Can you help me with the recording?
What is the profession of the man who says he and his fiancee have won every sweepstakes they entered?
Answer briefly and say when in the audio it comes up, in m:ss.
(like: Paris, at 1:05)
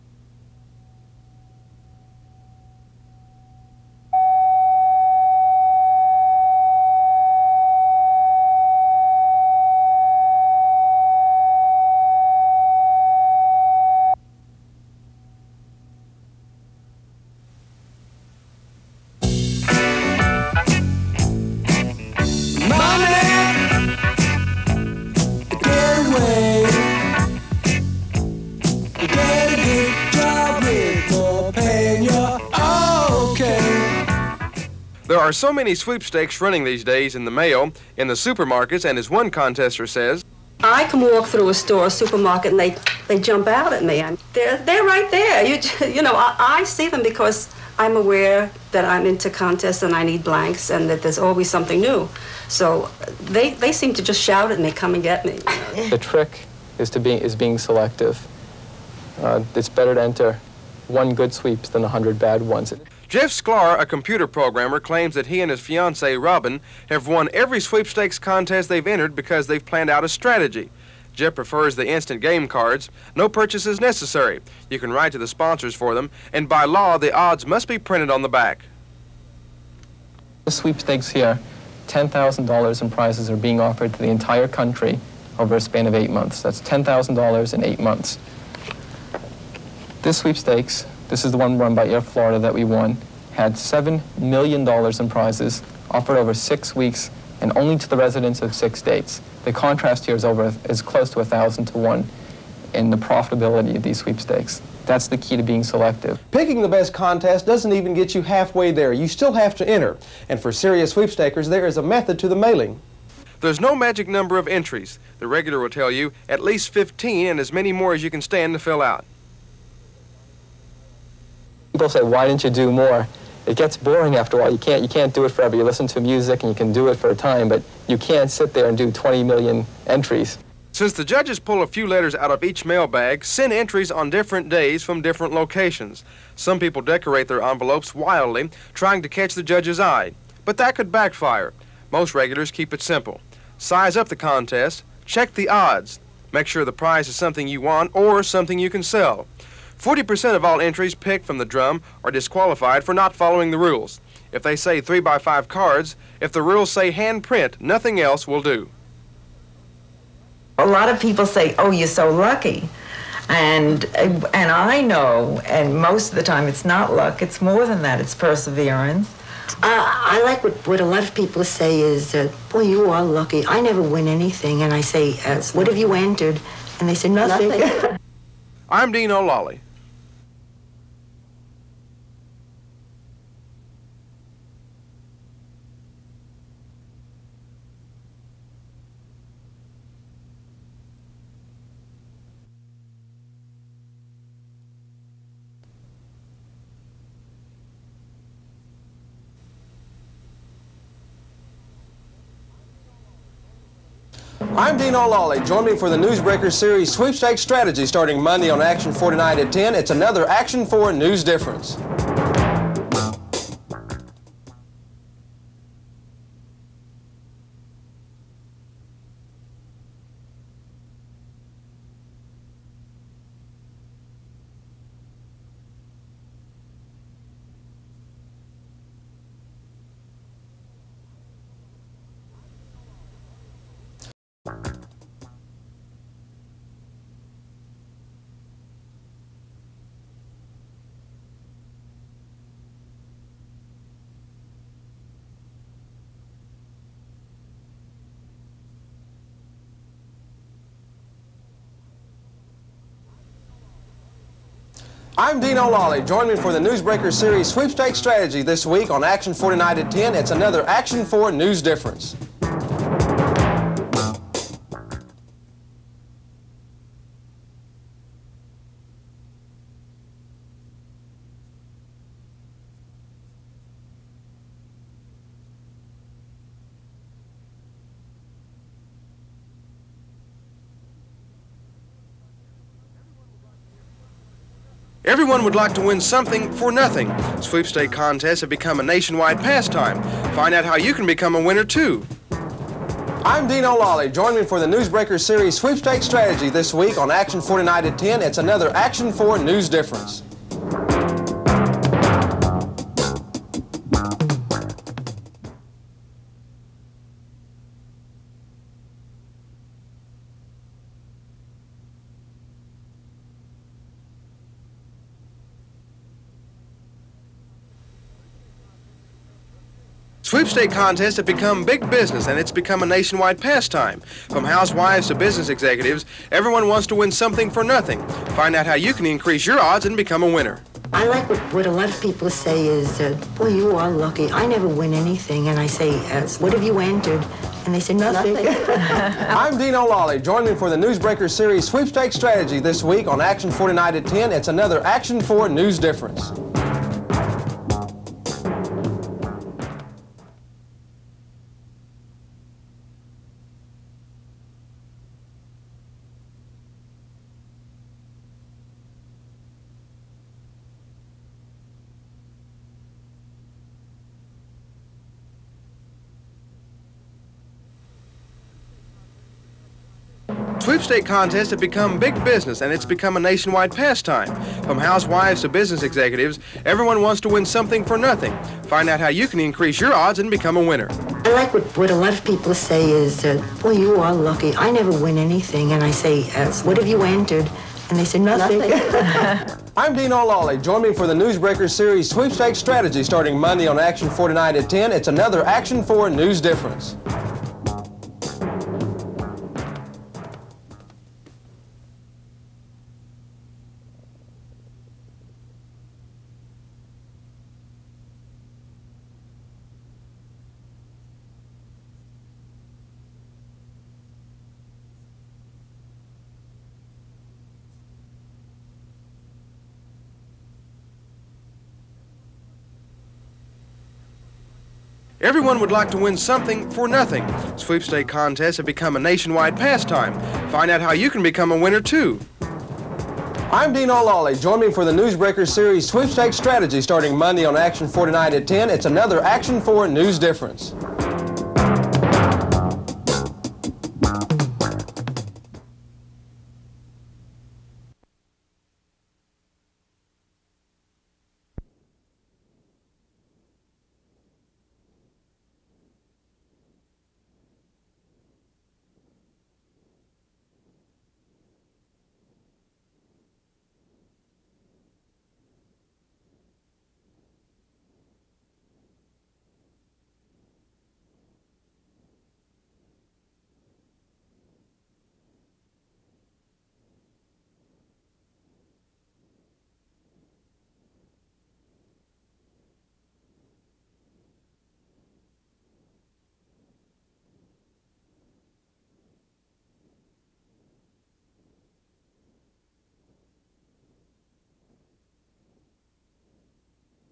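Computer programmer, at 1:03.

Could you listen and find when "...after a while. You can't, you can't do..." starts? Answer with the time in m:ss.
2:04.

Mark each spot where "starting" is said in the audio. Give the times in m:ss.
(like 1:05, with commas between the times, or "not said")
3:27, 6:33, 7:16.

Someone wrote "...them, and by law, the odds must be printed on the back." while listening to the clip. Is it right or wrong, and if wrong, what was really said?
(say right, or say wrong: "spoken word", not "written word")
right.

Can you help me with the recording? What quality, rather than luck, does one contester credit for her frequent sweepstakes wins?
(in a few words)
Perseverance.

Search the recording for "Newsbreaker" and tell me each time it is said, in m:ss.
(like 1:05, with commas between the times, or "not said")
3:25, 4:16, 4:54, 5:40, 6:31, 7:14.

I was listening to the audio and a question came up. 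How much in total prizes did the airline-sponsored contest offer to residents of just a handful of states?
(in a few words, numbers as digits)
$7 million.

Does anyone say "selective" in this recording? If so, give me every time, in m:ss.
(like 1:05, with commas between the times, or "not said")
0:57, 1:45.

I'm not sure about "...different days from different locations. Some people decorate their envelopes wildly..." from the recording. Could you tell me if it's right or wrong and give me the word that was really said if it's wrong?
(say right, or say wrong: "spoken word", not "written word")
right.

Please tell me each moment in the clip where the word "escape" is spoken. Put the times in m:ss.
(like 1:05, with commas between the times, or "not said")
not said.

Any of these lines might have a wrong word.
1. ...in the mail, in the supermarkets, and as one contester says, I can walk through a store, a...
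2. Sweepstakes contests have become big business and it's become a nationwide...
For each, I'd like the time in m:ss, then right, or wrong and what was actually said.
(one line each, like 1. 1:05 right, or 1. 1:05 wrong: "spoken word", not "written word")
1. 0:37 right
2. 5:20 right.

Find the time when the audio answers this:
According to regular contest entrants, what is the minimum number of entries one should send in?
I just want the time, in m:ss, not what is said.
1:56.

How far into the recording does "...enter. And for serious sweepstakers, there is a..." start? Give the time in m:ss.
1:49.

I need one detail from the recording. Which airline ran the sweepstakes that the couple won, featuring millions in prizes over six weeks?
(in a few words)
Air Florida.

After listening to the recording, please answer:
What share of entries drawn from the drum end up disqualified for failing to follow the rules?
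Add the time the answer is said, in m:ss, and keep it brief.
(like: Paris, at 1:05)
40%, at 2:29.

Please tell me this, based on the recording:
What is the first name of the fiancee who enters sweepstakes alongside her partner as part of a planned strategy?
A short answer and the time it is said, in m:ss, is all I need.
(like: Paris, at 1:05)
Robin, at 1:06.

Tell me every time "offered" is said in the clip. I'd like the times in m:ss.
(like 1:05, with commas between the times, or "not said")
1:23, 1:35.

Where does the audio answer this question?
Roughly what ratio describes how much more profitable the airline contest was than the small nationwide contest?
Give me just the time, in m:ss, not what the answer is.
1:41.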